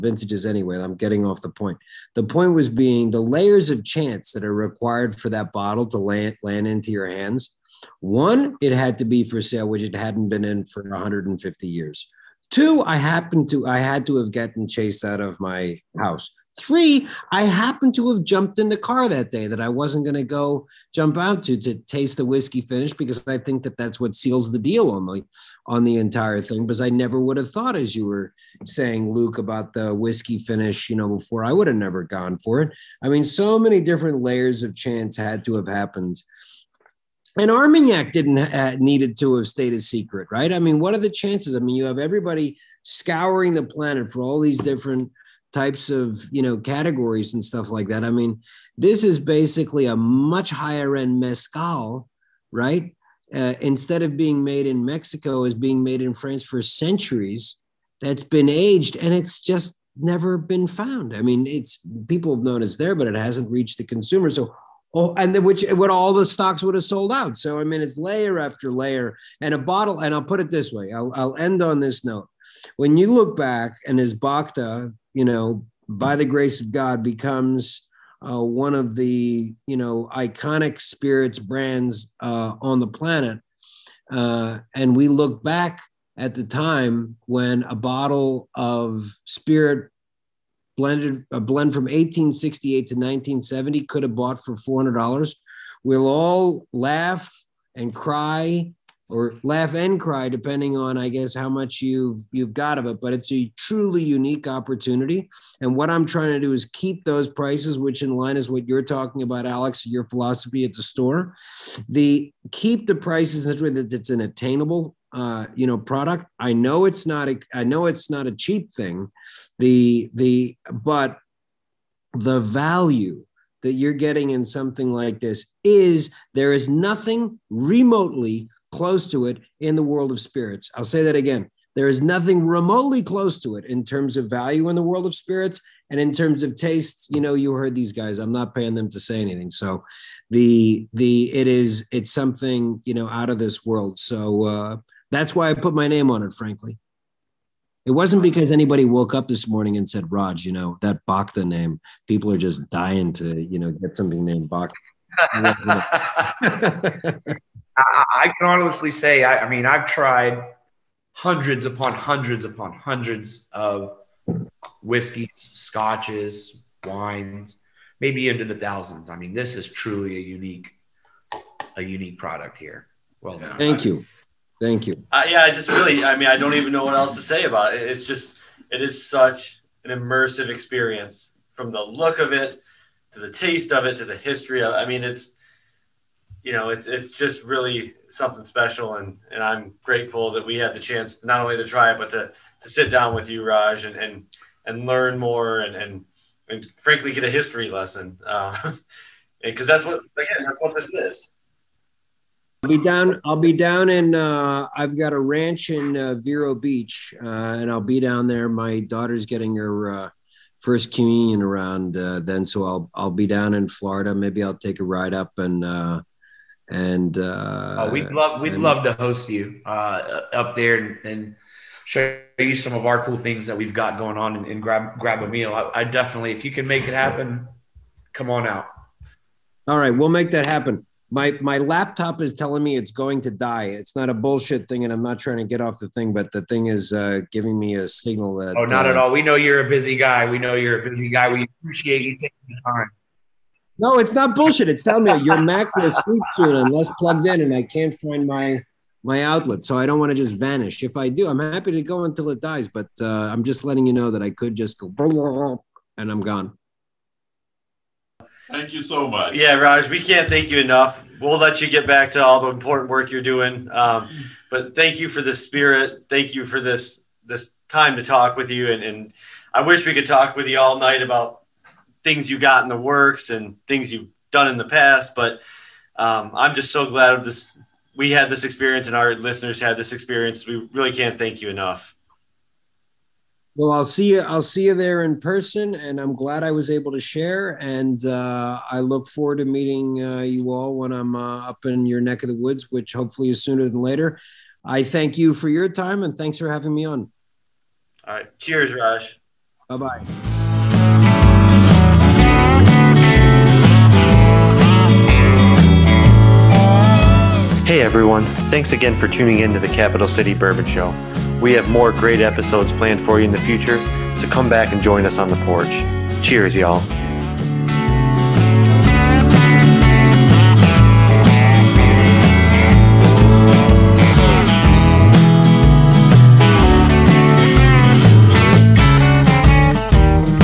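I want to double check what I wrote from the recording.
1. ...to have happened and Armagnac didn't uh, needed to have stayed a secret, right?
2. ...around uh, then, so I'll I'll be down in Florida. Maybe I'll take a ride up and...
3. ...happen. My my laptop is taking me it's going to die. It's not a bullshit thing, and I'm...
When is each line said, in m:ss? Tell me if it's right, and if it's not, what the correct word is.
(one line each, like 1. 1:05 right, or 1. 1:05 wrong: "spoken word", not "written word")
1. 0:35 right
2. 3:31 right
3. 3:50 wrong: "telling", not "taking".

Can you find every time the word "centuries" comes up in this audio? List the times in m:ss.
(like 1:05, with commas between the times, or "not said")
0:56.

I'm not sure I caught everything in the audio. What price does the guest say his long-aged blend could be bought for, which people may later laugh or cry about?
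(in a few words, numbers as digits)
$400.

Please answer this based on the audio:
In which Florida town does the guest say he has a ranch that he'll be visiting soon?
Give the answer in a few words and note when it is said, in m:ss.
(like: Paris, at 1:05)
Vero Beach, at 3:26.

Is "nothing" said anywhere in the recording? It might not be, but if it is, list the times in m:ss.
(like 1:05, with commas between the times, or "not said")
2:06, 2:12.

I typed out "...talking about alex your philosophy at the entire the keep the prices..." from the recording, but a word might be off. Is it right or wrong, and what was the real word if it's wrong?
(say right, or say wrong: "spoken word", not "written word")
wrong: "store", not "entire".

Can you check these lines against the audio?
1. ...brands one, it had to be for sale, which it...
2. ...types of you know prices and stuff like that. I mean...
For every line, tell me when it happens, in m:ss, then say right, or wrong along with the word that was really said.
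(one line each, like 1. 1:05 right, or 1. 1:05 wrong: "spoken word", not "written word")
1. 0:07 wrong: "hands", not "brands"
2. 0:45 wrong: "categories", not "prices".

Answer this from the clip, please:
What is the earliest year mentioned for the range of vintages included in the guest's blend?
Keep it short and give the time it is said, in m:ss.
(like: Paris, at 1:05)
1868, at 1:31.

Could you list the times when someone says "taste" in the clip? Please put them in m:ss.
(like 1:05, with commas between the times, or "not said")
0:21, 2:16, 3:03.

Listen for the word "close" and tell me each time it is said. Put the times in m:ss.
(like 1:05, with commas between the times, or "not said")
2:08, 2:13.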